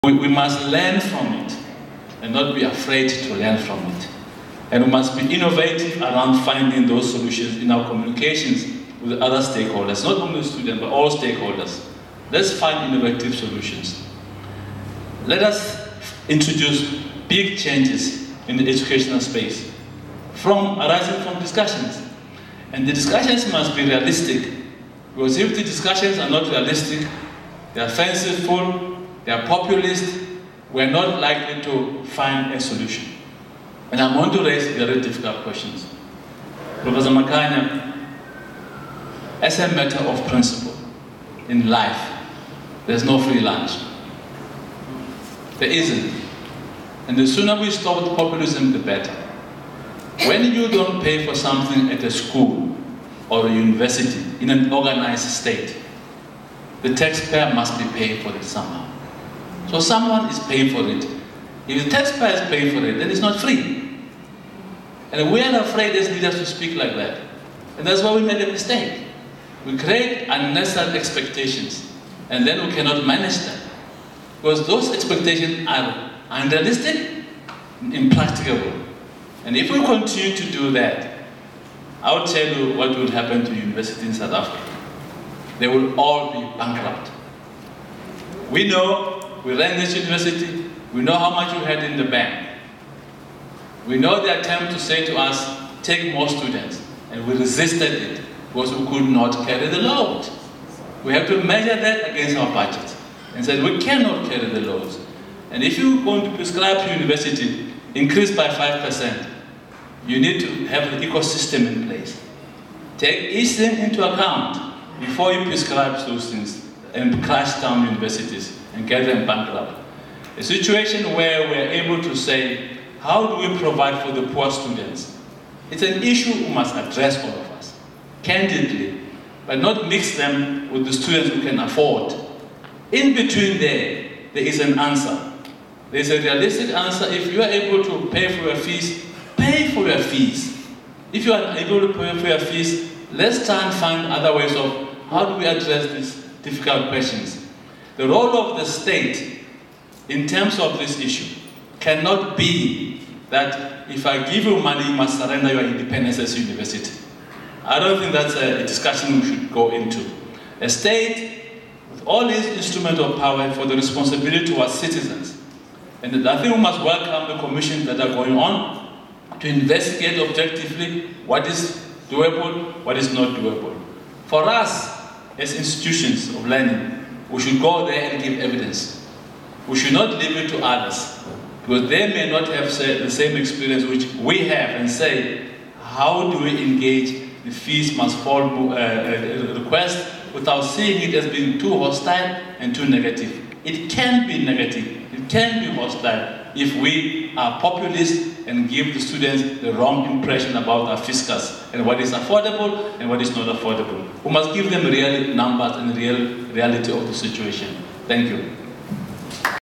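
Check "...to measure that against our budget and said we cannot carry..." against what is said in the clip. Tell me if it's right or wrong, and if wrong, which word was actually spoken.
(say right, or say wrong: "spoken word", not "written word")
right.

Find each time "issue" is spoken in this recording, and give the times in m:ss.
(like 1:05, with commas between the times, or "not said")
2:06, 2:30.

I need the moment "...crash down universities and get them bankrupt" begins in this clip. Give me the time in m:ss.
1:57.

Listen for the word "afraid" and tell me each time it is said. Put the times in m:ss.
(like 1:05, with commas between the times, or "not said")
0:02, 1:05.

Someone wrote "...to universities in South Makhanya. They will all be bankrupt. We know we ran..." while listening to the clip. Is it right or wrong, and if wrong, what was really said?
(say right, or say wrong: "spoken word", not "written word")
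wrong: "Africa", not "Makhanya".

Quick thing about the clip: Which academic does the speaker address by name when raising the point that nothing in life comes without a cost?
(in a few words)
Professor Makhanya.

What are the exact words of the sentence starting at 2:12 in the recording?
In between there, there is an answer.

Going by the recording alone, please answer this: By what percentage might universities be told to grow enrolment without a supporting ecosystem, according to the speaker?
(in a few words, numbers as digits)
5%.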